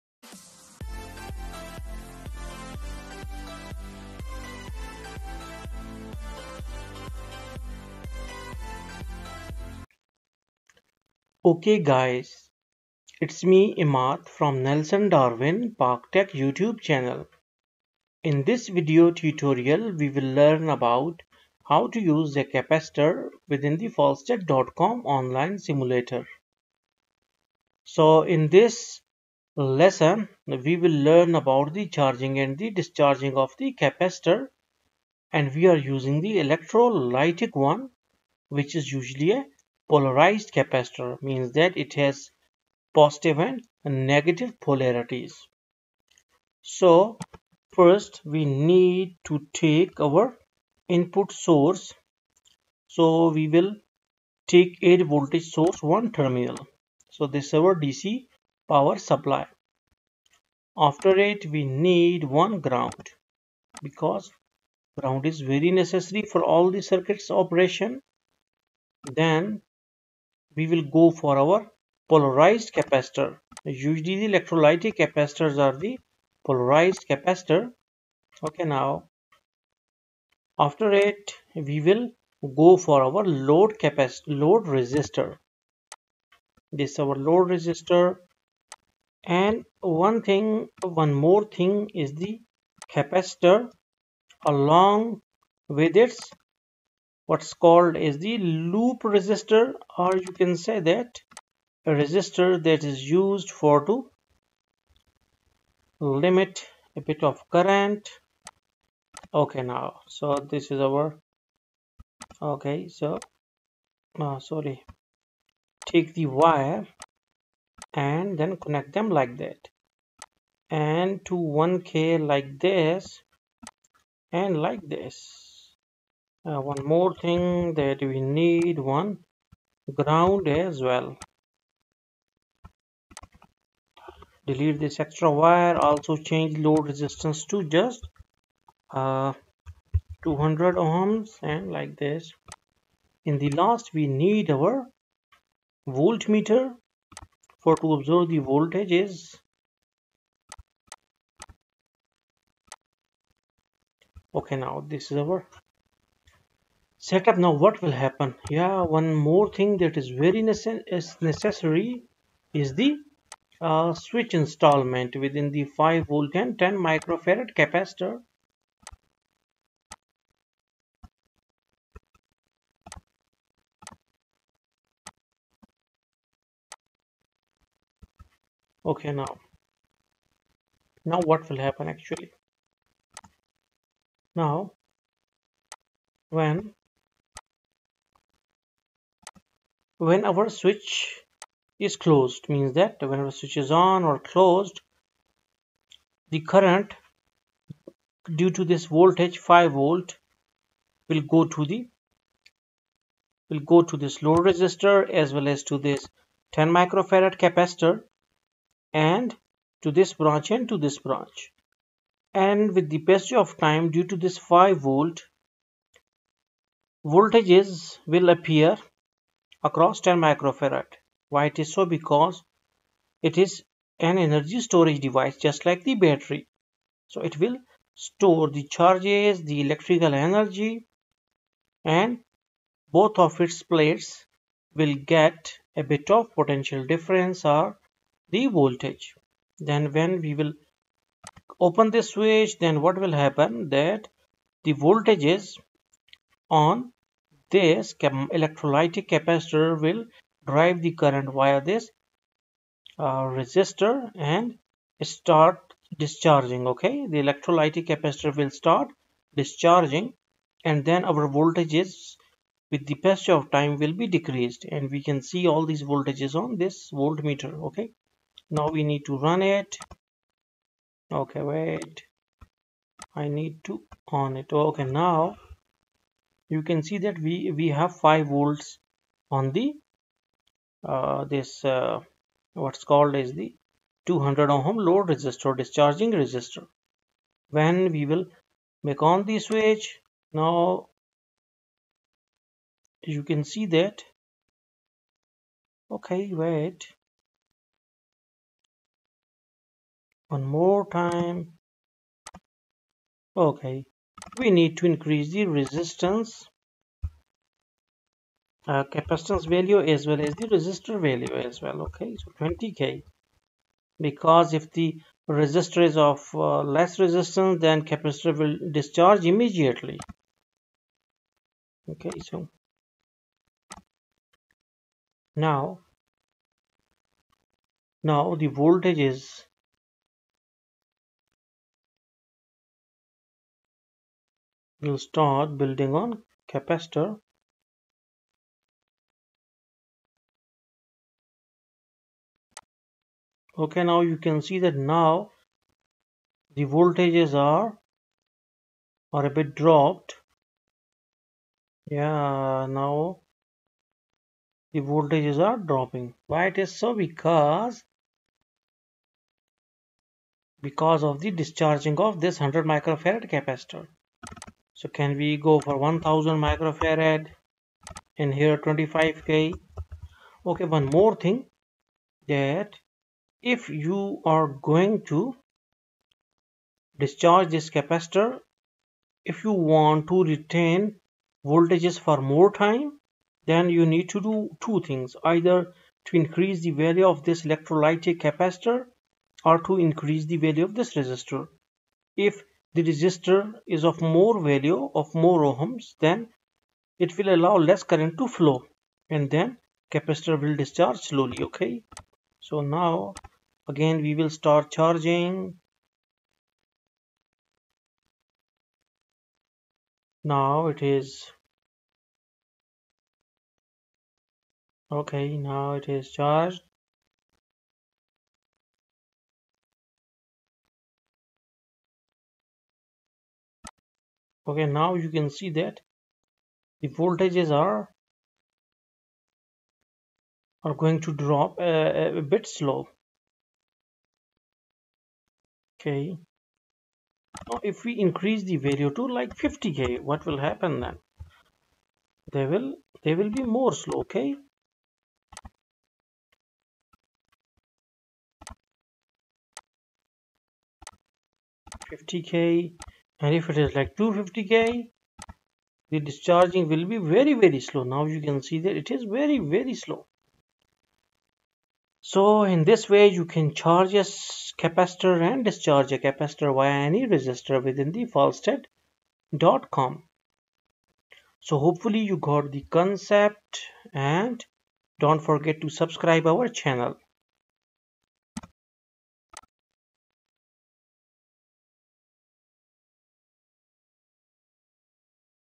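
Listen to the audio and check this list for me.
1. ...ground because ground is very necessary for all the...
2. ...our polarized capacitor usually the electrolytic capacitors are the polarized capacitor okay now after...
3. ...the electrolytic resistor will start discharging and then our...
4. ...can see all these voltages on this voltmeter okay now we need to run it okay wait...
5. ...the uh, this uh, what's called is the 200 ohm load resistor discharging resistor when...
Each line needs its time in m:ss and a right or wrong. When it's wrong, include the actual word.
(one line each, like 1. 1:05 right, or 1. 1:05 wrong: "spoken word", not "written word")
1. 1:02 right
2. 1:11 right
3. 4:17 wrong: "capacitor", not "resistor"
4. 4:25 right
5. 4:39 right.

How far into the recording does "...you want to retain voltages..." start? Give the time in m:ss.
6:19.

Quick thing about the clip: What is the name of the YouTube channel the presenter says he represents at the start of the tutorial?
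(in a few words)
Nelson Darwin Pak Tech.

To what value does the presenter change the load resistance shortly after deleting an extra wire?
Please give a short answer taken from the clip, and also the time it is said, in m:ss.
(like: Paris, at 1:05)
200 ohms, at 2:20.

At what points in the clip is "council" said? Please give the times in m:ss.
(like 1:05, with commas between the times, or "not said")
not said.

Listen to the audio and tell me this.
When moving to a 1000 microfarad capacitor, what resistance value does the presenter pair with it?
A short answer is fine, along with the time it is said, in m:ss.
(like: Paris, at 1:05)
25k, at 6:08.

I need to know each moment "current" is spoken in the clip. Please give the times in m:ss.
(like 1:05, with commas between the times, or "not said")
1:47, 3:16, 4:10, 6:37.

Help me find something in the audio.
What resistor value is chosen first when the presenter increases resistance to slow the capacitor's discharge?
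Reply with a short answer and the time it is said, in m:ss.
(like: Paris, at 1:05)
20k, at 5:12.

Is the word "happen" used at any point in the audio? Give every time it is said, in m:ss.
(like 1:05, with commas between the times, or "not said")
2:38, 3:01, 4:03, 7:20.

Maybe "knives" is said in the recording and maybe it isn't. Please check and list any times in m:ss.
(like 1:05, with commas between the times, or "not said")
not said.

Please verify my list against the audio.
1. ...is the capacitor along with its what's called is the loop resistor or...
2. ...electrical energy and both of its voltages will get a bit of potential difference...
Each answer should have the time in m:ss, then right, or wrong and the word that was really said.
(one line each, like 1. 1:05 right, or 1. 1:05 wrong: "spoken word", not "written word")
1. 1:32 right
2. 3:49 wrong: "plates", not "voltages".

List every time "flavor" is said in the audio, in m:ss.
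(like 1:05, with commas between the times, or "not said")
not said.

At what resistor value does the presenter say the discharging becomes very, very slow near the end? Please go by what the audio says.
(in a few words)
250k.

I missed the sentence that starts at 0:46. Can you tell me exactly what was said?
So first we need to take our input source.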